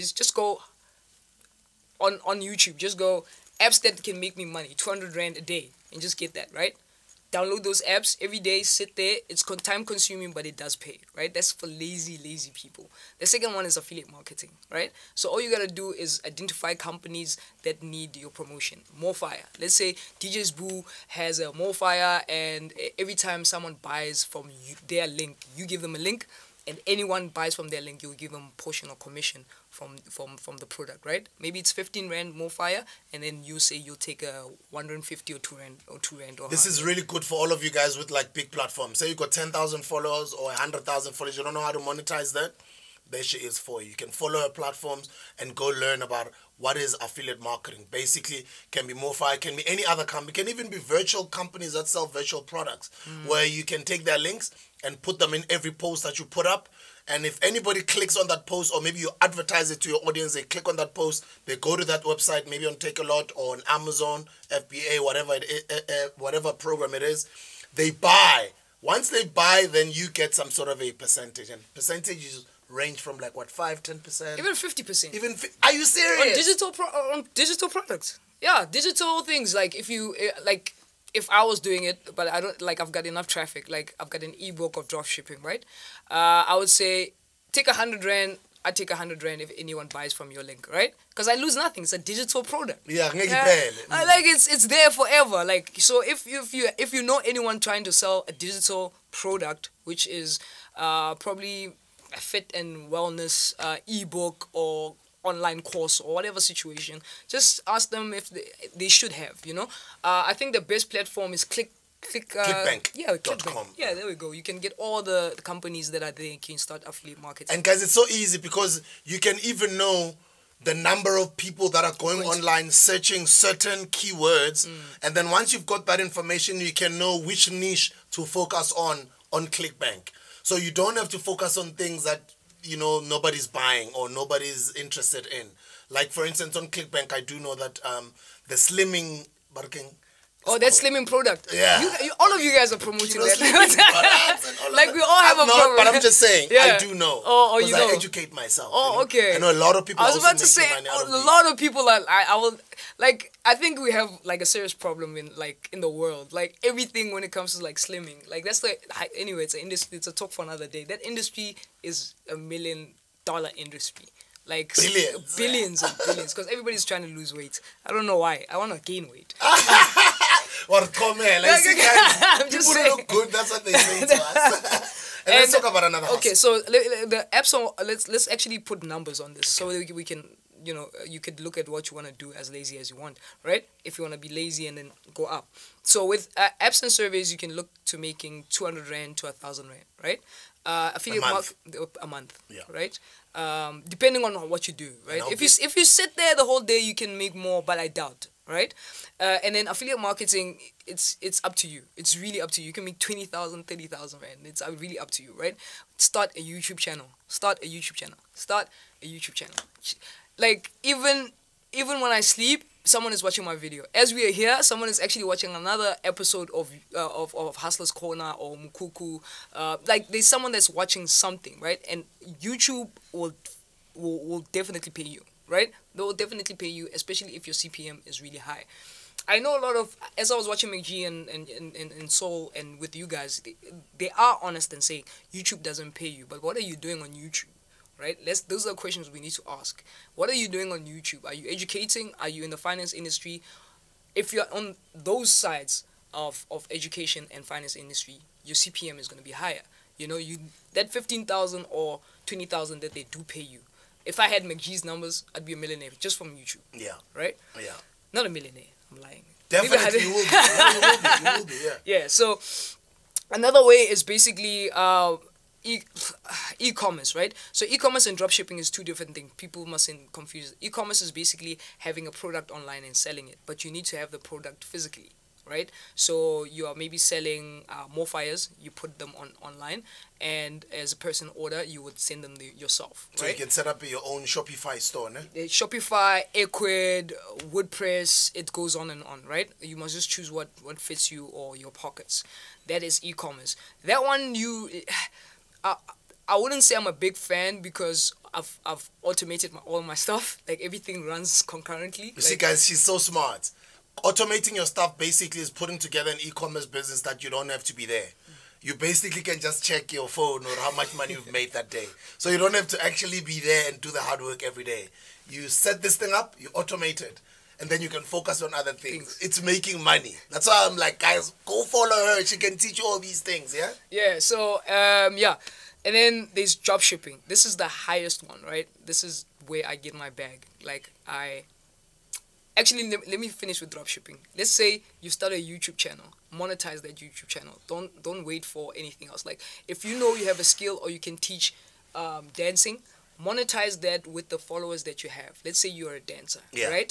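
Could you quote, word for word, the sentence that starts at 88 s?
I take a hundred rand if anyone buys from your link, right?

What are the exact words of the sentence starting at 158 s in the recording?
Like that's like anyway, it's an industry.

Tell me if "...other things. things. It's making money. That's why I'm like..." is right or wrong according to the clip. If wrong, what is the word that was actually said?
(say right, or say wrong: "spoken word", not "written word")
right.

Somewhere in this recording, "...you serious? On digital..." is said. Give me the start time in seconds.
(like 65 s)
75 s.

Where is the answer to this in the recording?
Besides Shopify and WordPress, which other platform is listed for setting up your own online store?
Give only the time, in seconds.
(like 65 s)
286 s.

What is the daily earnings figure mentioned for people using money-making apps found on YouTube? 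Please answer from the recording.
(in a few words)
200 rand.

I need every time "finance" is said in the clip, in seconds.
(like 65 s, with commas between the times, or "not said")
242 s, 247 s.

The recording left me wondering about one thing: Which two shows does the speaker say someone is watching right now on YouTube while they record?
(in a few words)
Hustler's Corner or Mukuku.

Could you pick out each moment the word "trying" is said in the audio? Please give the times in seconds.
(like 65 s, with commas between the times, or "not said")
97 s, 166 s.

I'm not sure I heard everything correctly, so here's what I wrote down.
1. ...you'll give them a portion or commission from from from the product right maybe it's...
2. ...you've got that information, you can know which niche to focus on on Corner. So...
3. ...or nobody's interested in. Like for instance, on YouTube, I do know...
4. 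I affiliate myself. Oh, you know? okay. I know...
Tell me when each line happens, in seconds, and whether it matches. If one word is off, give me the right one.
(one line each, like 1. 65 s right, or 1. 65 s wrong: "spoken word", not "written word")
1. 28 s right
2. 125 s wrong: "ClickBank", not "Corner"
3. 133 s wrong: "ClickBank", not "YouTube"
4. 147 s wrong: "educate", not "affiliate".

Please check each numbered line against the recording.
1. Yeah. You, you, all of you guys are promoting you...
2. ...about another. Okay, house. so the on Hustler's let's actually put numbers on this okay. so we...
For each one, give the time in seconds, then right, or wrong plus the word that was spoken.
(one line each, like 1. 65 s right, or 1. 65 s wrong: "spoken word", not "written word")
1. 141 s right
2. 175 s wrong: "Let", not "Hustler".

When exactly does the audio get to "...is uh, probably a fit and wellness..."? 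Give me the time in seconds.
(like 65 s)
100 s.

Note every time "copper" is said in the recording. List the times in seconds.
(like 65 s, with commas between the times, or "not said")
not said.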